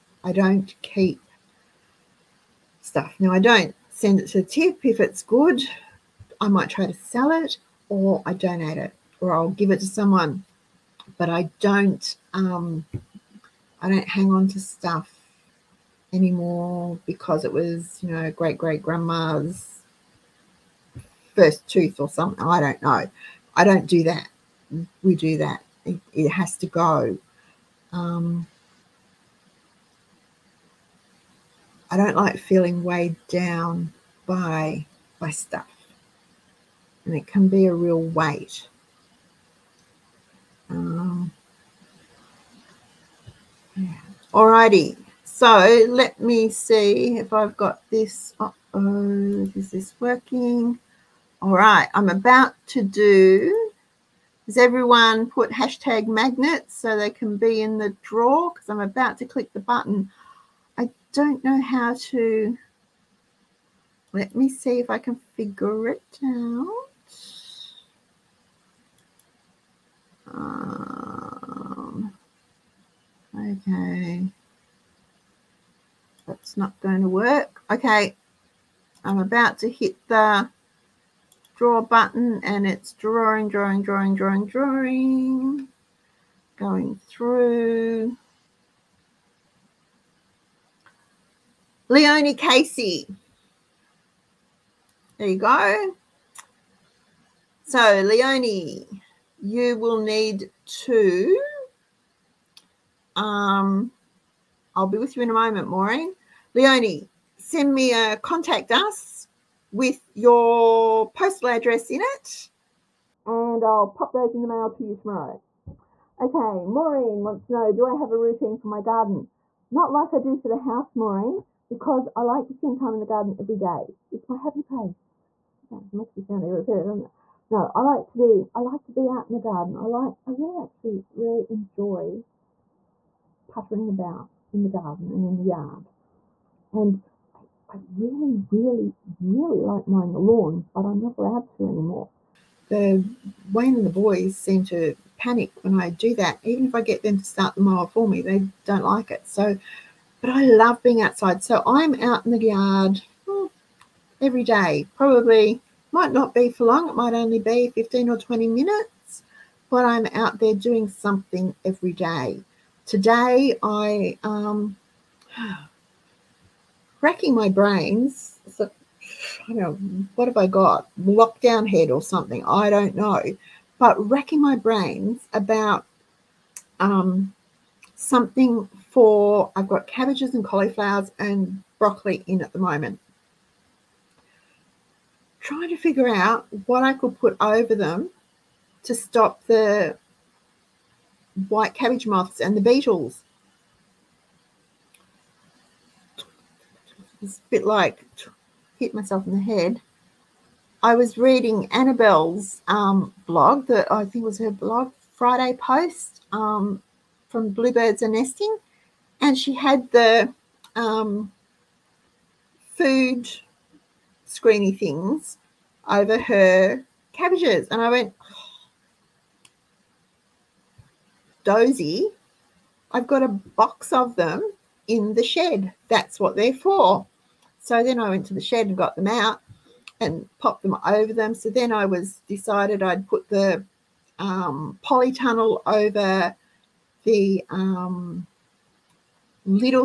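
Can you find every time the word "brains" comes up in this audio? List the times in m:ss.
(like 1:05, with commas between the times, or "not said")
2:47, 2:54.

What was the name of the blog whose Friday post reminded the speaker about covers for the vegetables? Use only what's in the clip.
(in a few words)
Bluebirds and Nesting.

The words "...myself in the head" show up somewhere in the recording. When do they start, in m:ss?
3:18.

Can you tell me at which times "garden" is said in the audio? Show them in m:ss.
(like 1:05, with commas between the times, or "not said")
1:58, 2:03, 2:09, 2:14.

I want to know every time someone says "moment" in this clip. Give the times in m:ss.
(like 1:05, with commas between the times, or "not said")
1:45, 3:02.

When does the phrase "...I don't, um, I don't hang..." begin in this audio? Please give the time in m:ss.
0:11.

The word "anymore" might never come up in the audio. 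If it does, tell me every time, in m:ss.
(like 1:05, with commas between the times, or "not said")
0:16, 2:21.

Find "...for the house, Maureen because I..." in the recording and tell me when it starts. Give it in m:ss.
2:00.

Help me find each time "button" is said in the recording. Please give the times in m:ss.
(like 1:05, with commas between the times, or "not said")
0:59, 1:21.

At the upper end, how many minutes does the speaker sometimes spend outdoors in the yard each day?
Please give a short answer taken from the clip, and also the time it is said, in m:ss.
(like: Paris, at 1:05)
20, at 2:38.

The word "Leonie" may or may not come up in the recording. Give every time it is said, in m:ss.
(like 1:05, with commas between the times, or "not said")
1:31, 1:38, 1:46.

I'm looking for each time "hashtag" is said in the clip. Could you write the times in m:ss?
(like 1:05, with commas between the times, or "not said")
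0:55.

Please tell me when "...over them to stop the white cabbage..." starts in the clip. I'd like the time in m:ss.
3:07.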